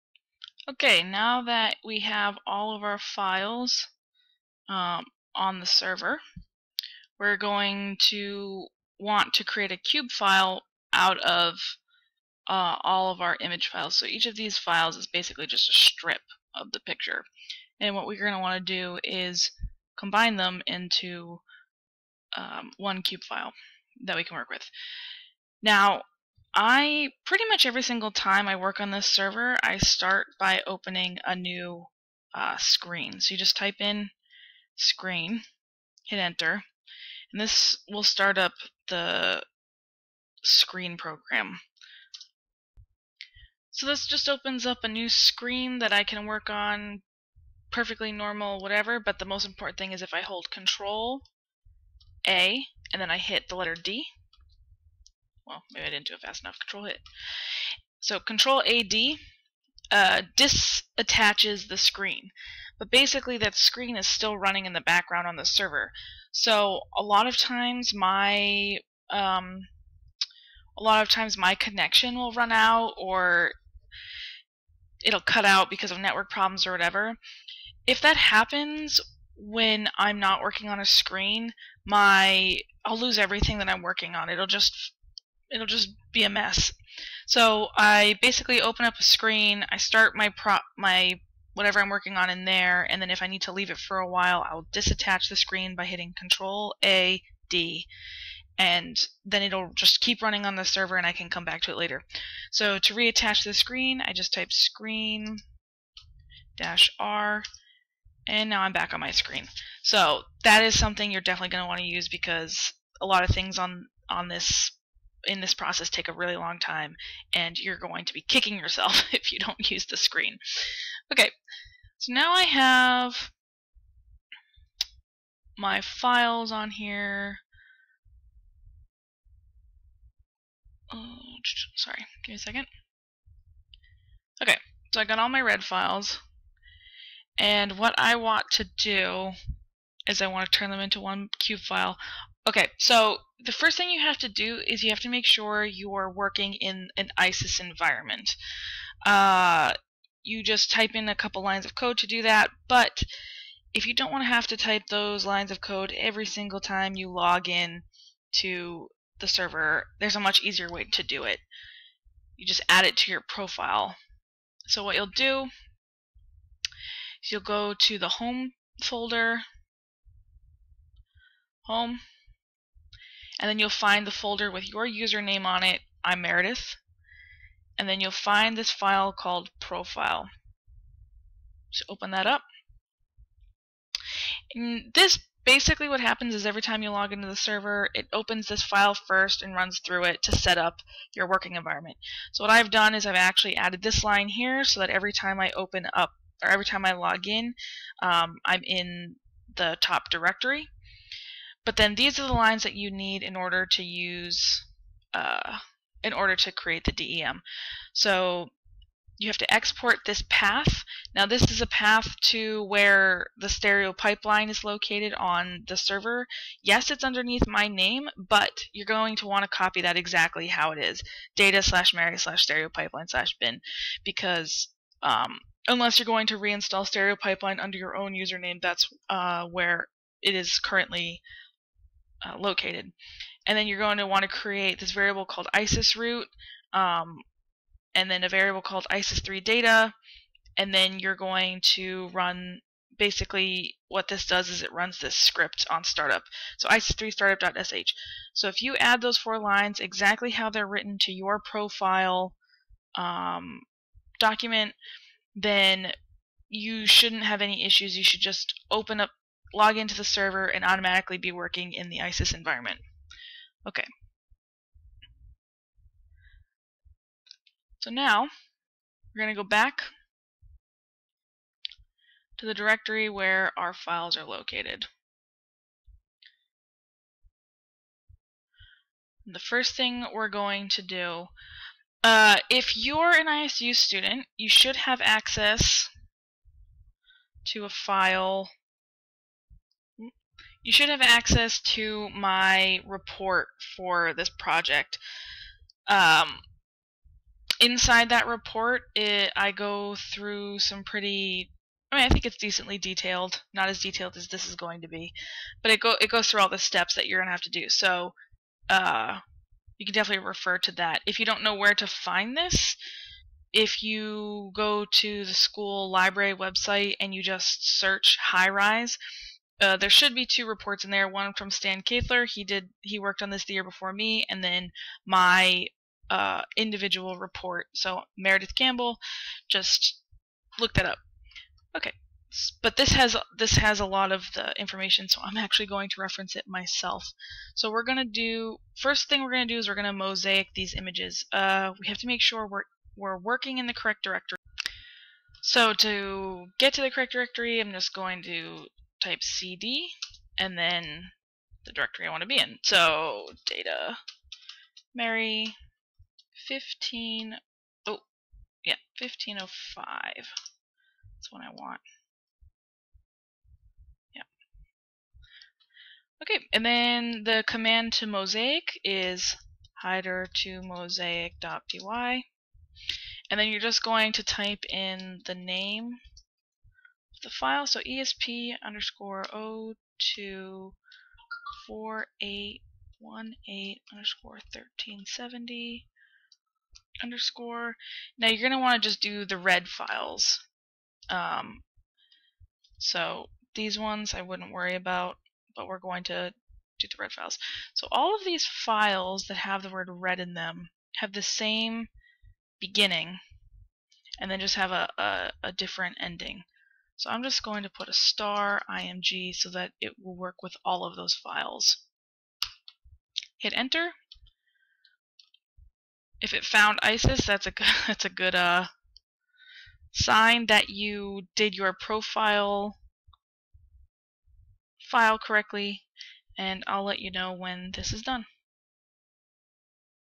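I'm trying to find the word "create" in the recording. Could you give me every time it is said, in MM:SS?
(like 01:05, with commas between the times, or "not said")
00:09, 03:26, 03:54.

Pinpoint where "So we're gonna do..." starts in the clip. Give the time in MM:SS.
05:37.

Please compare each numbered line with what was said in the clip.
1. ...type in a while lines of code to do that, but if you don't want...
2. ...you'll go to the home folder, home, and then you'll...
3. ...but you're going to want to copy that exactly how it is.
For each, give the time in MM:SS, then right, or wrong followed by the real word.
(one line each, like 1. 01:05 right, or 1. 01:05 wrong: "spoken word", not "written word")
1. 02:30 wrong: "couple", not "while"
2. 02:47 right
3. 03:38 right.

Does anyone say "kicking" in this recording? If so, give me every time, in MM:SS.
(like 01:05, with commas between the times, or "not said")
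01:58.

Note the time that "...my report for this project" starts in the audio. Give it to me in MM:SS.
04:52.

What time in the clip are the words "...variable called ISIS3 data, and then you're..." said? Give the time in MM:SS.
03:58.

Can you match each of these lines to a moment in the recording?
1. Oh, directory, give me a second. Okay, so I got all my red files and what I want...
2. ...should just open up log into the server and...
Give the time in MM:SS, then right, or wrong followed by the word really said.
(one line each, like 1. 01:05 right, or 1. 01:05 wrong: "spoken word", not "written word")
1. 02:10 wrong: "sorry", not "directory"
2. 04:18 right.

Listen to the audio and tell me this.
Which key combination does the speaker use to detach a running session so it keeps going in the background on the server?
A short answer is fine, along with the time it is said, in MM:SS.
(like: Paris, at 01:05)
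Control A D, at 00:58.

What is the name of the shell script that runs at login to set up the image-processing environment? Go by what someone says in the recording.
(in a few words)
ISIS3 startup.sh.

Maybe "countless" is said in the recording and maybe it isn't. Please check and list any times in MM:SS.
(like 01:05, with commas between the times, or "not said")
not said.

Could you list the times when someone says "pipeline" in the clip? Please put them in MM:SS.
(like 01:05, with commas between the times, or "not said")
03:33, 03:42, 03:47.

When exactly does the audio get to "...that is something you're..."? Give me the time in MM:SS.
01:50.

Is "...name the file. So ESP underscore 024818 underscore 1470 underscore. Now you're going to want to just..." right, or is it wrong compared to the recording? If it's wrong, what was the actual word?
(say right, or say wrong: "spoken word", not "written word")
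wrong: "1370", not "1470".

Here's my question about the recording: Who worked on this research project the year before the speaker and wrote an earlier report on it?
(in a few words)
Stan Kathler.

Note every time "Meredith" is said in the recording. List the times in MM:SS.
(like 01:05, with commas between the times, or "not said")
02:56, 05:28.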